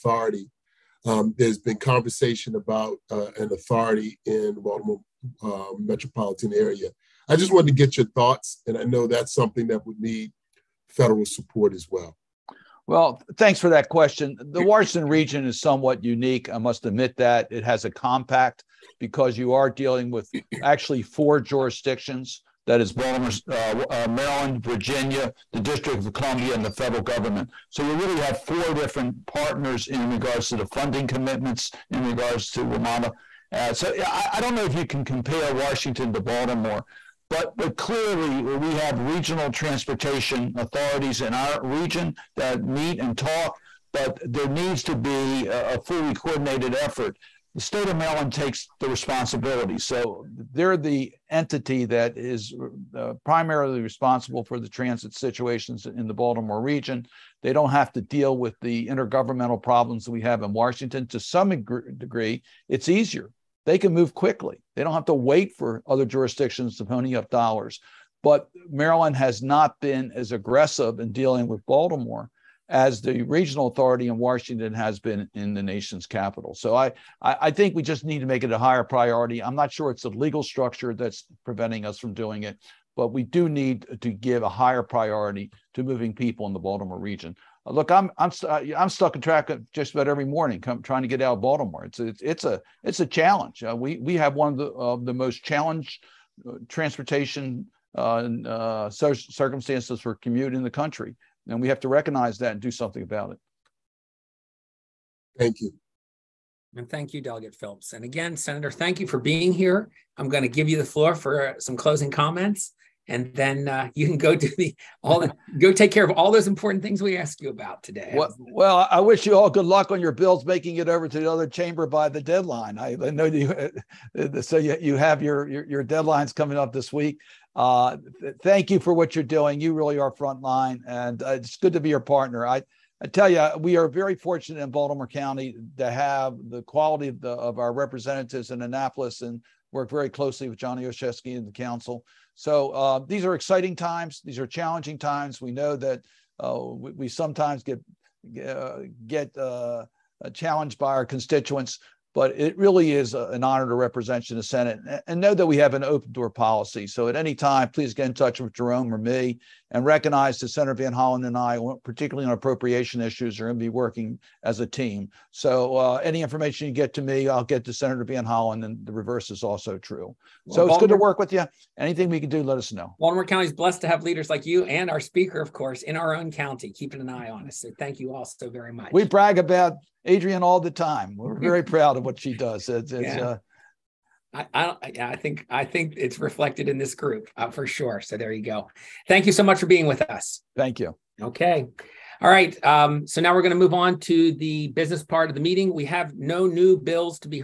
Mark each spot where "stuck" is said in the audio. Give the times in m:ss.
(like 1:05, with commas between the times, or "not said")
1:28.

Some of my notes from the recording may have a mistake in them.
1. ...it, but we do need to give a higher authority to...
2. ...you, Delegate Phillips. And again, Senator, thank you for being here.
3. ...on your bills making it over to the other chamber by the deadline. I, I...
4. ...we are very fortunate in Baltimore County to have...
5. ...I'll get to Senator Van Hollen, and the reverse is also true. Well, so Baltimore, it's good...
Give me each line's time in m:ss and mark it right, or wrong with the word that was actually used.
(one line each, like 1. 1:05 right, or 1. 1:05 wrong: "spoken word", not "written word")
1. 1:22 wrong: "priority", not "authority"
2. 1:47 right
3. 1:59 right
4. 2:13 right
5. 2:47 right.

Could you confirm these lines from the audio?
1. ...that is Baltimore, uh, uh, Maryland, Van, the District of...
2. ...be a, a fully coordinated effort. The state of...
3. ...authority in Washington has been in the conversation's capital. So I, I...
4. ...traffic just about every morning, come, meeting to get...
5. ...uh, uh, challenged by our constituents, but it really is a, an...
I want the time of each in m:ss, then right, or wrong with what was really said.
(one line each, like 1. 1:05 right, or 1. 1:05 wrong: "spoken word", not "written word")
1. 0:22 wrong: "Virginia", not "Van"
2. 0:44 right
3. 1:13 wrong: "nation", not "conversation"
4. 1:29 wrong: "trying", not "meeting"
5. 2:29 right.